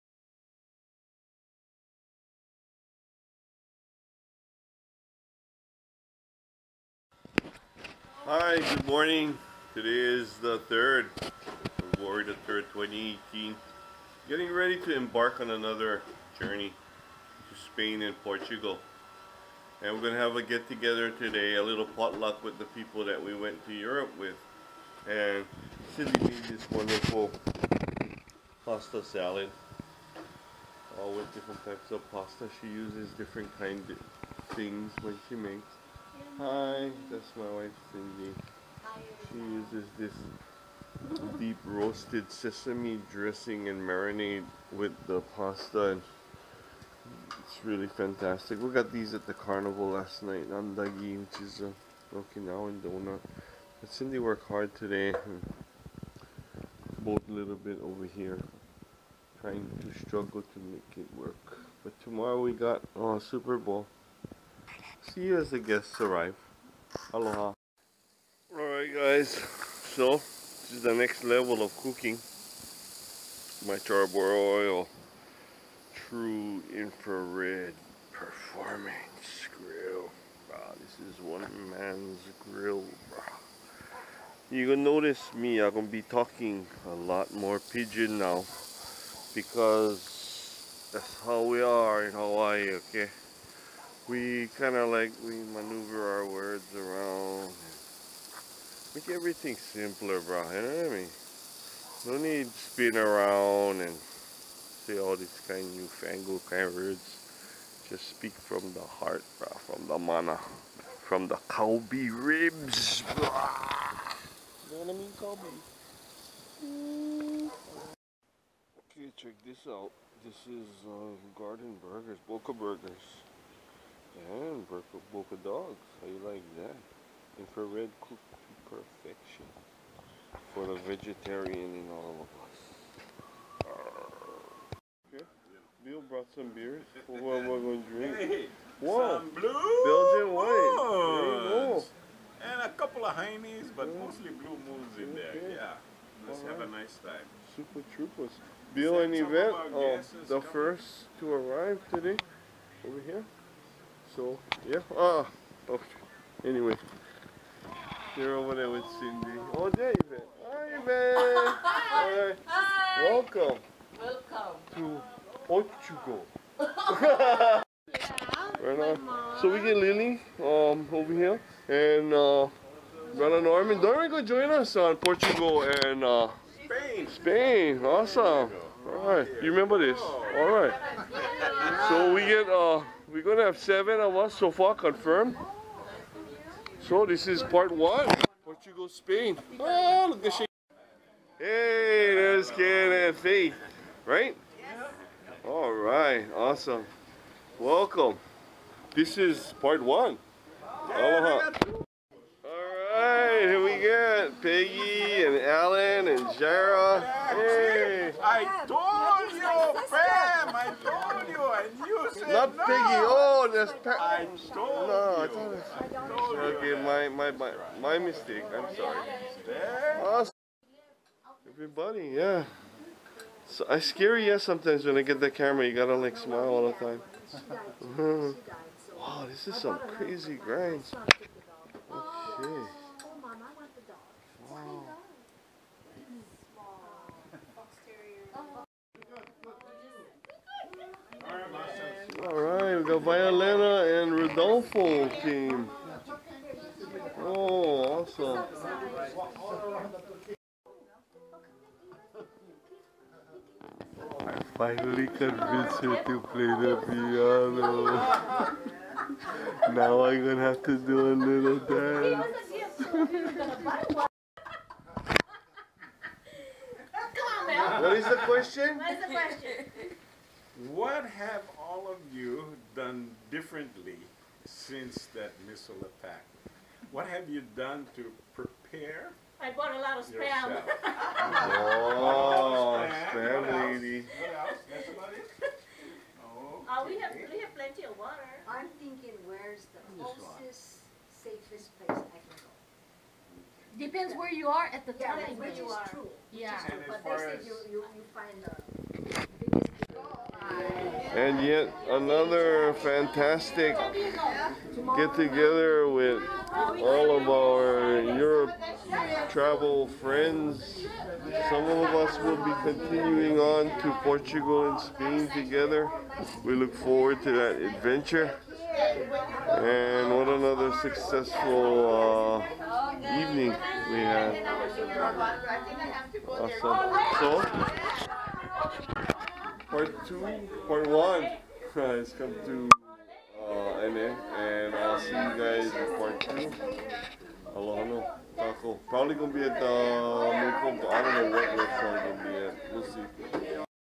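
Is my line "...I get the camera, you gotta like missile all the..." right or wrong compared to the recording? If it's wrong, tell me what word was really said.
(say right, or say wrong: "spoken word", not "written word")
wrong: "smile", not "missile".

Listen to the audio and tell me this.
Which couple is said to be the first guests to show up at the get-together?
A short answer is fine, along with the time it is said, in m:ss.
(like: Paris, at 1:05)
Bill and Yvette, at 2:28.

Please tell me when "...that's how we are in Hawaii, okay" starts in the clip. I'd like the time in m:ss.
1:30.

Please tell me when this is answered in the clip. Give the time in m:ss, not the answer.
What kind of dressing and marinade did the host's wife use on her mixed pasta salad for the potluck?
0:41.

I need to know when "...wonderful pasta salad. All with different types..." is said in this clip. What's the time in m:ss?
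0:26.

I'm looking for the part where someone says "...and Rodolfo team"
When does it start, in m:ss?
4:04.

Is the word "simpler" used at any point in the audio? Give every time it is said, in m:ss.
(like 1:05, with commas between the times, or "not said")
1:39.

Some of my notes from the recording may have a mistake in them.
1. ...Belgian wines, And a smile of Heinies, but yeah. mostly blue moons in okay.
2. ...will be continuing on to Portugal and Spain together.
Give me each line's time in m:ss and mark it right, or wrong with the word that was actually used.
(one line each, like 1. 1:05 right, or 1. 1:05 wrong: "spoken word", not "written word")
1. 2:20 wrong: "couple", not "smile"
2. 5:12 right.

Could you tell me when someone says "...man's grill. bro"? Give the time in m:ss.
1:21.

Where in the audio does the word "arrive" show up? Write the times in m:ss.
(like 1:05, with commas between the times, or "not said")
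1:05, 2:31.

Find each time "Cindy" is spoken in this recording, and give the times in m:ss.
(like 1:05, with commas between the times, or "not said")
0:25, 0:37, 0:53, 2:38.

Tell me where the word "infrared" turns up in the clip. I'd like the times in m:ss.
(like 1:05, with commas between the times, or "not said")
1:16, 2:07.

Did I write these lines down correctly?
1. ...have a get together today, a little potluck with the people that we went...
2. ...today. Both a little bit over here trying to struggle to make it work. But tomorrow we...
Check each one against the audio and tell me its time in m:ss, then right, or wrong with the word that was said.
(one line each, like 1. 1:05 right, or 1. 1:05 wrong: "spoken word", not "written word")
1. 0:20 right
2. 0:54 right.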